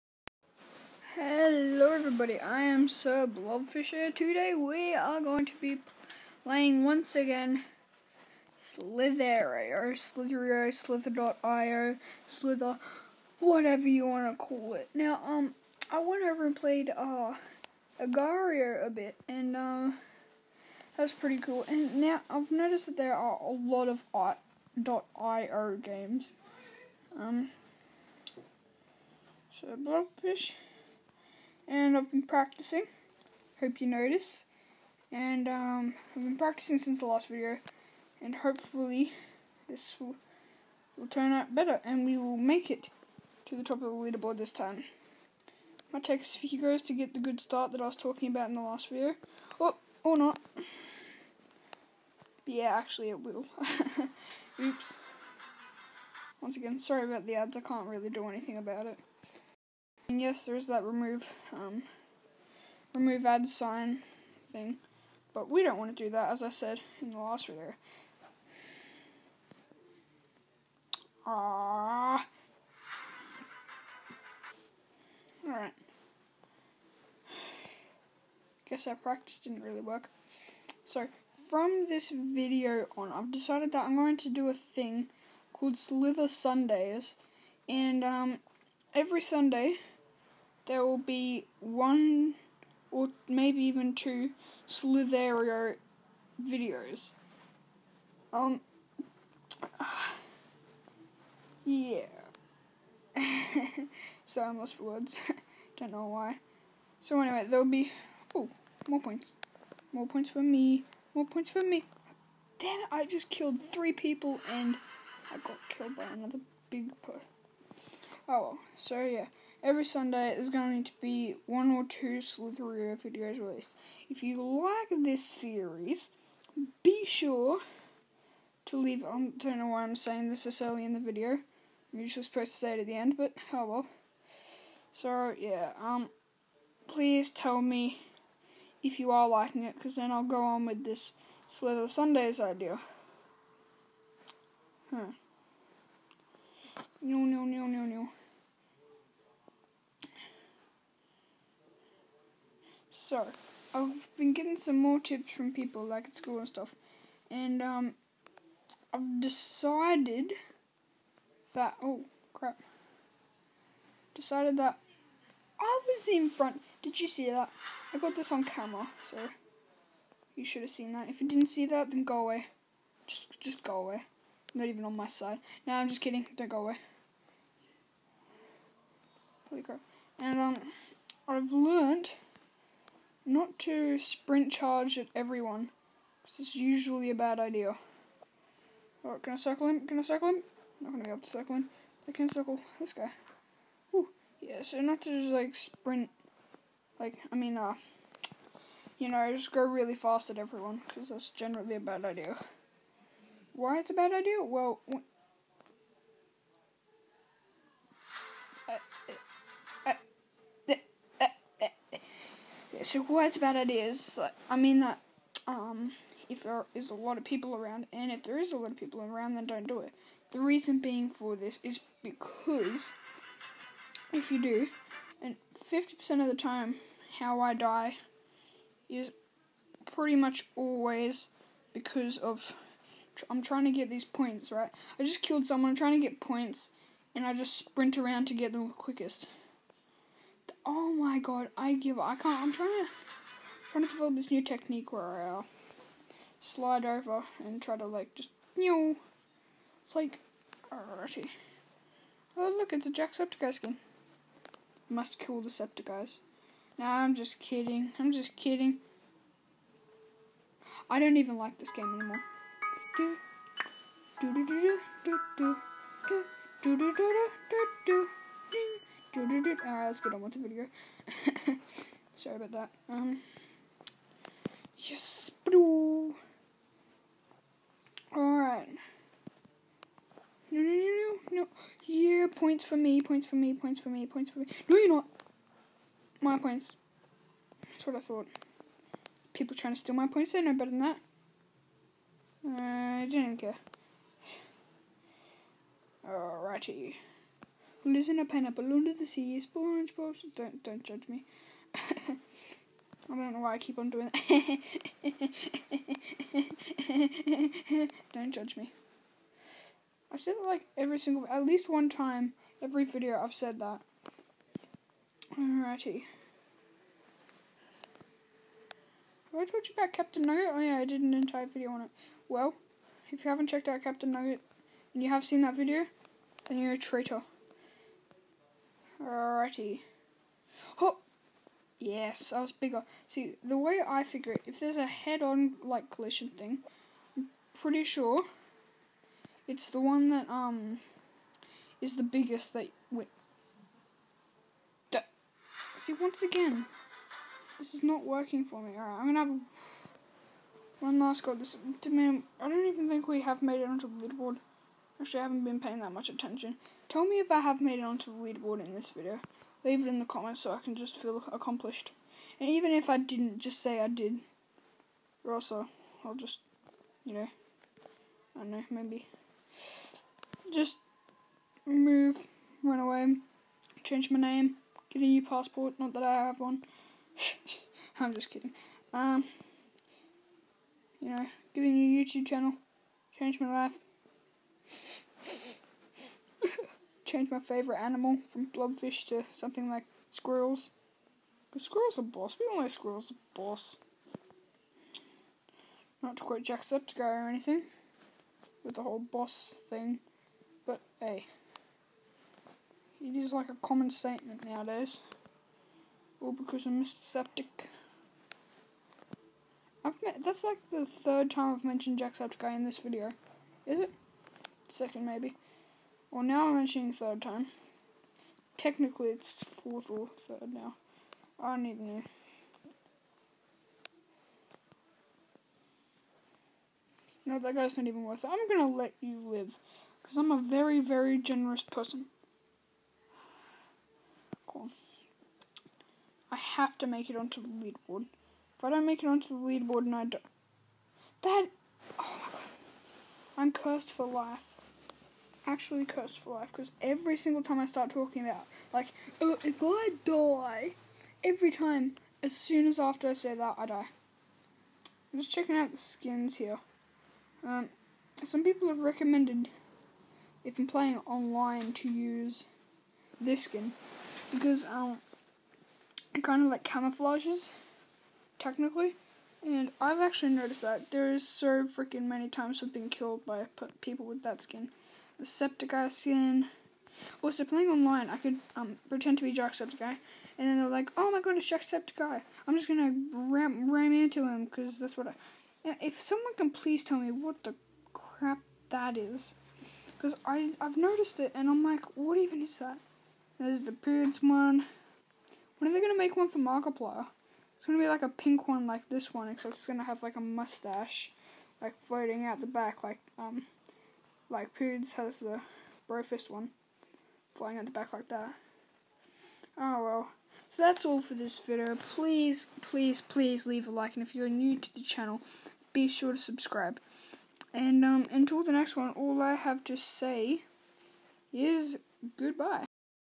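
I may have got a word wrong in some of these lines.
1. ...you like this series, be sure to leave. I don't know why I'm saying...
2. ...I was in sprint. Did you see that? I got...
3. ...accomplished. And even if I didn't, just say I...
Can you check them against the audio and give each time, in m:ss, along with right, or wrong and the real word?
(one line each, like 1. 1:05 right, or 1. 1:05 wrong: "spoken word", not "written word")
1. 2:04 right
2. 2:45 wrong: "front", not "sprint"
3. 6:01 right.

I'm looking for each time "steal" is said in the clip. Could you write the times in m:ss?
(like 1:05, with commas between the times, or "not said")
4:49.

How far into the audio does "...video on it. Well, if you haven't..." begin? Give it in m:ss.
5:21.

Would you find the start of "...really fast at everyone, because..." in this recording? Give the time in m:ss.
3:19.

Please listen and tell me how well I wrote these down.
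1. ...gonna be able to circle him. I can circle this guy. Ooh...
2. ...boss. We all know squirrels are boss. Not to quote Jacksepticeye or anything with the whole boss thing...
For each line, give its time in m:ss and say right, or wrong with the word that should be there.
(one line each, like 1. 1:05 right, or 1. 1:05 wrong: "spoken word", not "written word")
1. 3:10 right
2. 6:32 right.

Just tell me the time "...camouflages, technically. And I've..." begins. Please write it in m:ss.
7:46.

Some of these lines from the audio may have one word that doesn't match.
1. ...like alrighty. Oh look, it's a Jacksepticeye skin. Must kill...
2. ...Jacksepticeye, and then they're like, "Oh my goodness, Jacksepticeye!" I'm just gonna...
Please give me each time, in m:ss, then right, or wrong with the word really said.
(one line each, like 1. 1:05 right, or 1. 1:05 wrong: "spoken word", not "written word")
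1. 4:09 right
2. 7:59 right.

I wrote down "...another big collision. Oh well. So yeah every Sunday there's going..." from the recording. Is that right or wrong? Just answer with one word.
wrong.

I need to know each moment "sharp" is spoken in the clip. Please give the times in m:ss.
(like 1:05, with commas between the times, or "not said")
not said.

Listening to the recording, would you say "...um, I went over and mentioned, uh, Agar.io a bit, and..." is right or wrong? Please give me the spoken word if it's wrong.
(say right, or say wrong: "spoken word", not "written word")
wrong: "played", not "mentioned".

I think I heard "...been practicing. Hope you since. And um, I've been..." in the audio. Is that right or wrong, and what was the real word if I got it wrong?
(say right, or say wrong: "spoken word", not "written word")
wrong: "notice", not "since".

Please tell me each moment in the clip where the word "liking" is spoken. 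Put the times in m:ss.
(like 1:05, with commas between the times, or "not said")
2:19.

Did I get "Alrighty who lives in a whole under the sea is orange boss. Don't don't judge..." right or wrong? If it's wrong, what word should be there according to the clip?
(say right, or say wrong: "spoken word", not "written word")
wrong: "pineapple", not "whole".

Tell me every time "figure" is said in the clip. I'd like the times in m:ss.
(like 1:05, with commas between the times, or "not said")
5:34.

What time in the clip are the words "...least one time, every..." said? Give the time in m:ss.
5:11.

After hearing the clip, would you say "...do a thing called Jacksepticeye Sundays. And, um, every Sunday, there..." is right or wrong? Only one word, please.
wrong.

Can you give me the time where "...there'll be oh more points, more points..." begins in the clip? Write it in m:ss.
1:47.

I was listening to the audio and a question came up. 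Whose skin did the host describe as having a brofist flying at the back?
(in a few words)
Pewds.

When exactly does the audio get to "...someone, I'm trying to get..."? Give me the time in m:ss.
3:55.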